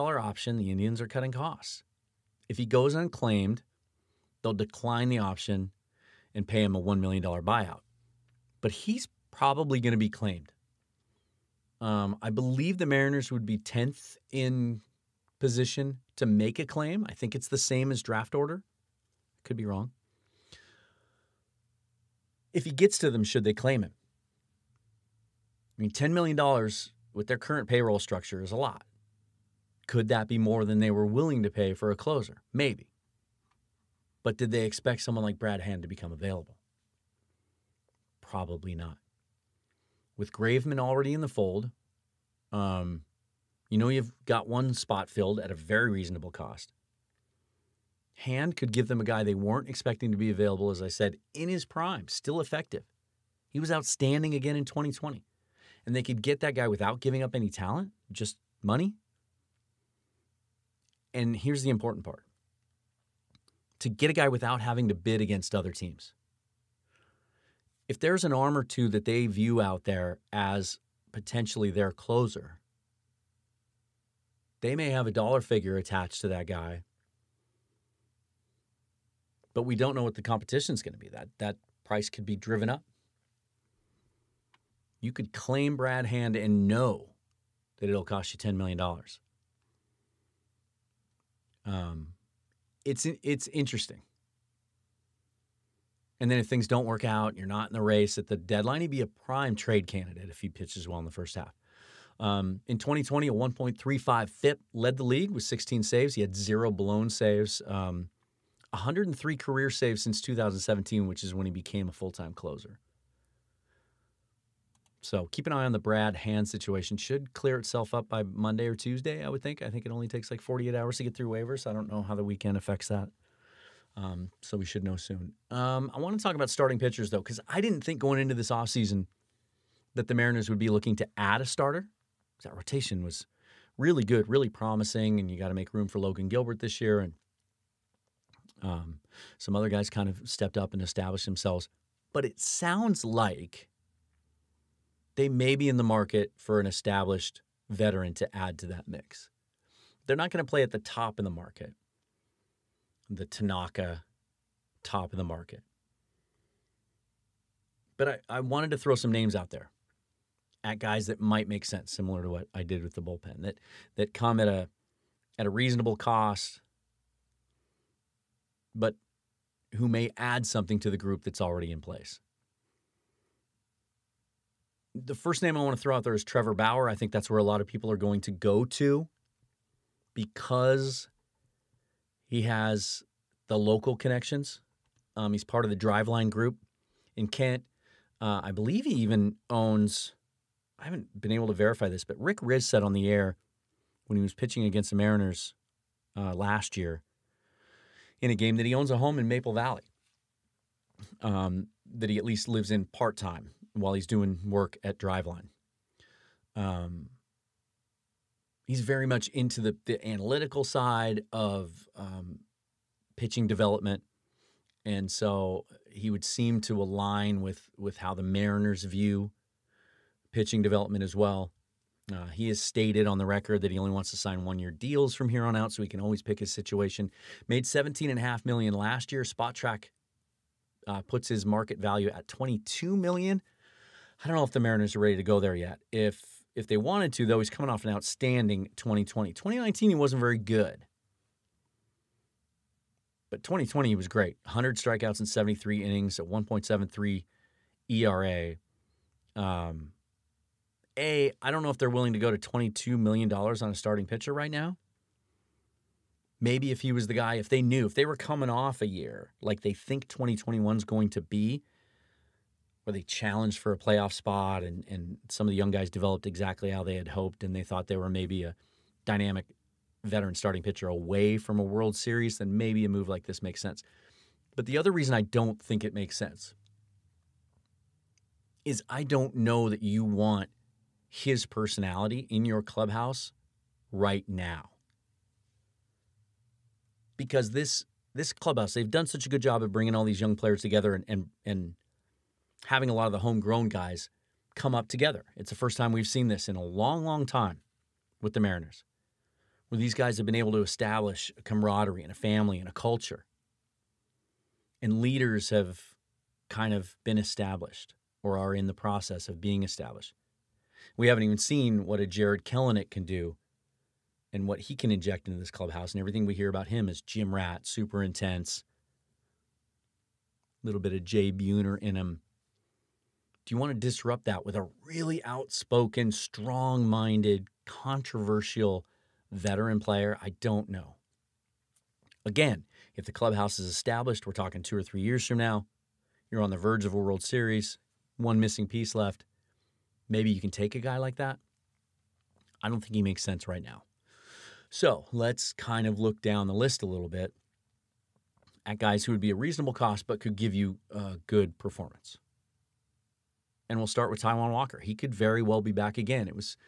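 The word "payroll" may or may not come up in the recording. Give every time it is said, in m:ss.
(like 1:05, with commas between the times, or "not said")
0:27.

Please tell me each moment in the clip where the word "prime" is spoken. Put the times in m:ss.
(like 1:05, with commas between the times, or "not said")
0:51, 1:39.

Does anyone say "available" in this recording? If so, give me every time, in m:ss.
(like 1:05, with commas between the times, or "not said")
0:36, 0:50.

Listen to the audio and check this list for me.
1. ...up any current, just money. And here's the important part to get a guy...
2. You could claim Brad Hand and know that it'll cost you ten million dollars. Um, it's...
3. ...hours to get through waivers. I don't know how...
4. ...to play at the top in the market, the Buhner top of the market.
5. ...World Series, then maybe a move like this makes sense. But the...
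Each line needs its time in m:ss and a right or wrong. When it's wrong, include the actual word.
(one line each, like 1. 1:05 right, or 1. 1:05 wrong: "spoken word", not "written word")
1. 0:57 wrong: "talent", not "current"
2. 1:25 right
3. 2:00 right
4. 2:30 wrong: "Tanaka", not "Buhner"
5. 4:31 right.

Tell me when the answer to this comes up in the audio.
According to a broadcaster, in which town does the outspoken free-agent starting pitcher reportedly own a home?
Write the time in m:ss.
3:19.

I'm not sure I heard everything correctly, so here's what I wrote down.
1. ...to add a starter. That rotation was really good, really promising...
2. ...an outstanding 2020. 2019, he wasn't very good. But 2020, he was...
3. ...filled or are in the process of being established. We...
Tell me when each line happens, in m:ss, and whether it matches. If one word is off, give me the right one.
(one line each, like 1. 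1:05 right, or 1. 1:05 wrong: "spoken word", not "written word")
1. 2:10 right
2. 3:57 right
3. 5:07 wrong: "established", not "filled".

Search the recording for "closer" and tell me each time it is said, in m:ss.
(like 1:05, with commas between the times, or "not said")
0:31, 1:11, 1:52.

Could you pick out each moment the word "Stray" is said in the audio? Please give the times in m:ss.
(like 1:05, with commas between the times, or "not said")
not said.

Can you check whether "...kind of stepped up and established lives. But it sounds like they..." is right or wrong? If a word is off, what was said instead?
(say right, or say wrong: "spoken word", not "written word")
wrong: "themselves", not "lives".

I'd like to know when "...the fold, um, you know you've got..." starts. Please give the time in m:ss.
0:41.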